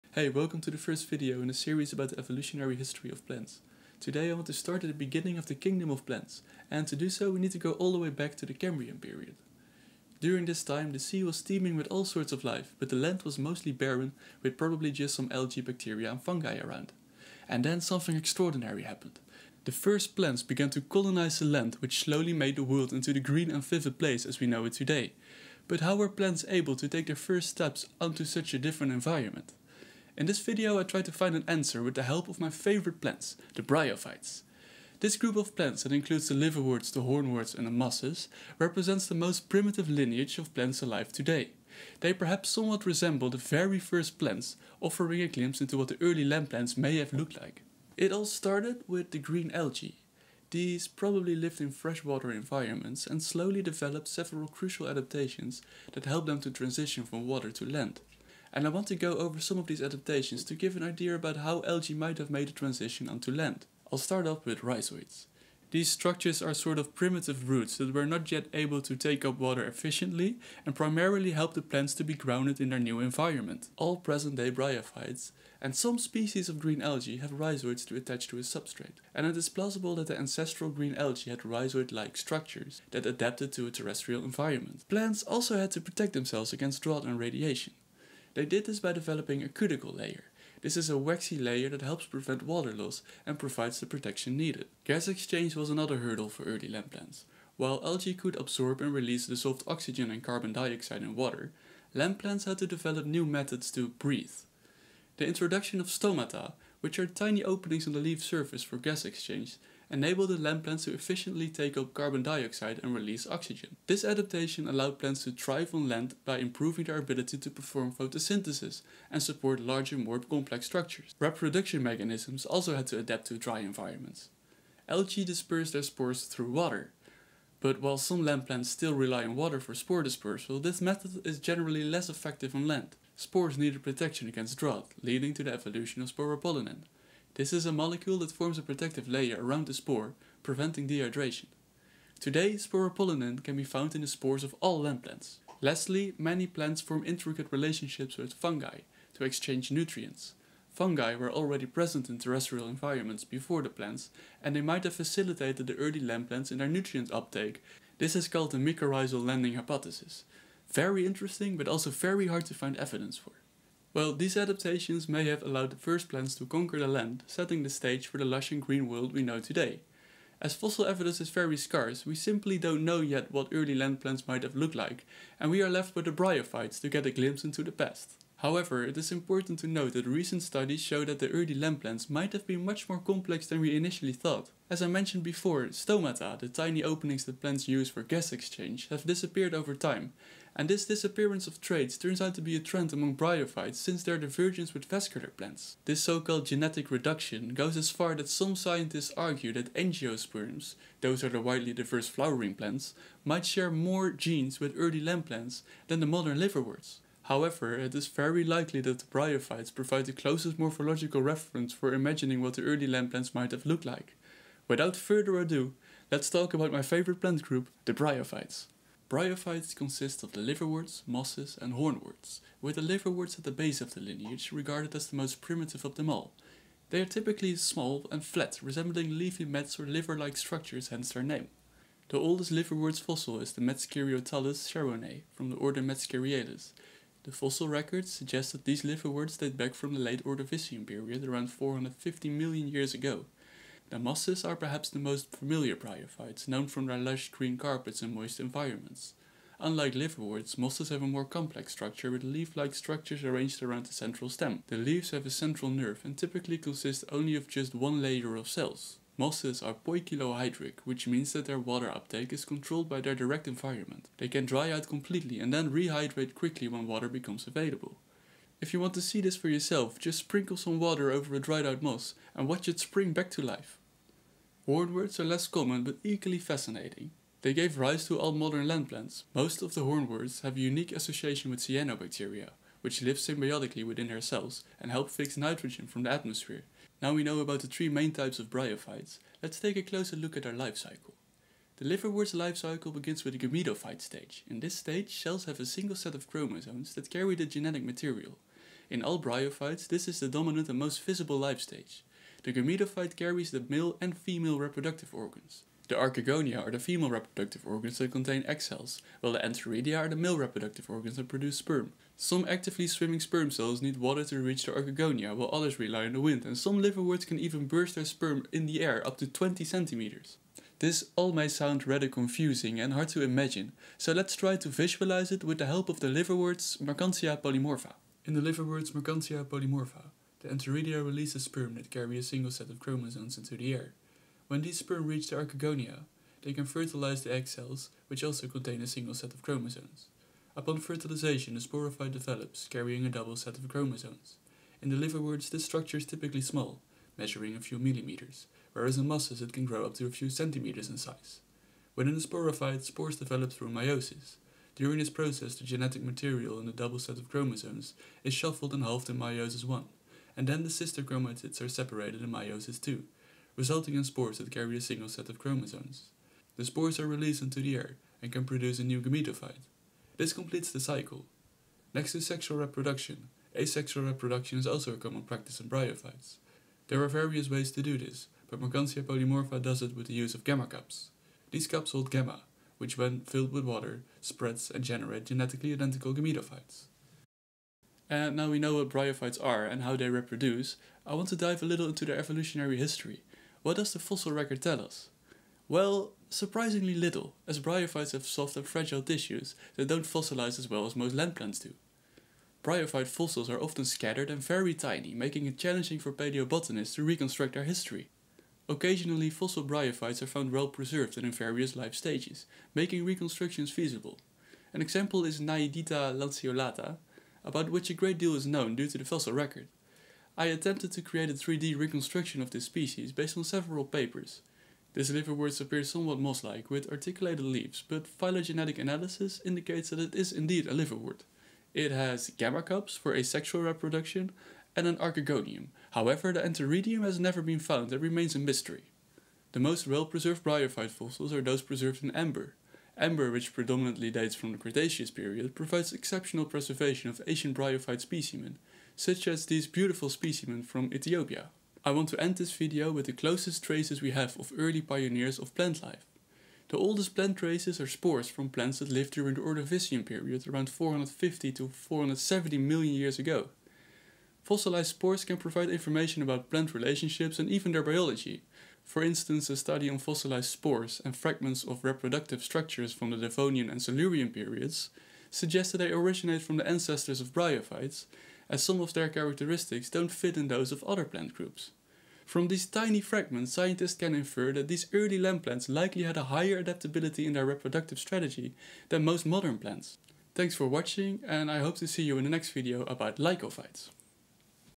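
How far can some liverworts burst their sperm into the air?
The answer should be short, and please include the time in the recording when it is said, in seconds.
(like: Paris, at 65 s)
20 centimeters, at 319 s.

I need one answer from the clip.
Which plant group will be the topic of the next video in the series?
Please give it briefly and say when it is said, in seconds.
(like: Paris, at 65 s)
lycophytes, at 493 s.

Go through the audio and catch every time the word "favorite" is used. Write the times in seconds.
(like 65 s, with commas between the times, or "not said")
32 s, 216 s.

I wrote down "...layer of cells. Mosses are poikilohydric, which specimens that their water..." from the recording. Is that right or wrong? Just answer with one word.
wrong.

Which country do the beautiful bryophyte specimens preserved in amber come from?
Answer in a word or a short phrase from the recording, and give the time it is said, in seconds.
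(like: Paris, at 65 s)
Ethiopia, at 450 s.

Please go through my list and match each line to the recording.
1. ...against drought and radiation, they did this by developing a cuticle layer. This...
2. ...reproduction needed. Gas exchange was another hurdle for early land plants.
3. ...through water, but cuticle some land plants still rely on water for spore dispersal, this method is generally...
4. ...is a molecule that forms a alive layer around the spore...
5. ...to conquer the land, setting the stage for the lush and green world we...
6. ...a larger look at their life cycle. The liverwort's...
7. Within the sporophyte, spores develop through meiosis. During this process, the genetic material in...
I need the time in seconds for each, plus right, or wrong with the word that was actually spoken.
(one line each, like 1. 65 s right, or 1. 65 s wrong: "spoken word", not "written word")
1. 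86 s right
2. 93 s wrong: "protection", not "reproduction"
3. 126 s wrong: "while", not "cuticle"
4. 137 s wrong: "protective", not "alive"
5. 166 s right
6. 289 s wrong: "closer", not "larger"
7. 351 s right.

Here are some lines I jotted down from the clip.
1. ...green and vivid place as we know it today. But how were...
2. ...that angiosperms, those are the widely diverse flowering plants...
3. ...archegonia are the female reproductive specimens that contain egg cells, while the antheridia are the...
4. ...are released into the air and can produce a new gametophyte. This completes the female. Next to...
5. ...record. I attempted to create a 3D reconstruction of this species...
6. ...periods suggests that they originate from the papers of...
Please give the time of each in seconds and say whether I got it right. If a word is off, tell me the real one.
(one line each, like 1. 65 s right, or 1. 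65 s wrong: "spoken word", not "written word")
1. 23 s right
2. 199 s right
3. 305 s wrong: "organs", not "specimens"
4. 366 s wrong: "cycle", not "female"
5. 419 s right
6. 474 s wrong: "ancestors", not "papers".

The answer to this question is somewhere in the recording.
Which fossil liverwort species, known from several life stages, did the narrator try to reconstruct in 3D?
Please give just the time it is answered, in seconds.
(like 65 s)
415 s.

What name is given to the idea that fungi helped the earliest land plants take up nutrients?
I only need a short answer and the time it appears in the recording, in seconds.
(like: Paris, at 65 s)
mycorrhizal landing hypothesis, at 158 s.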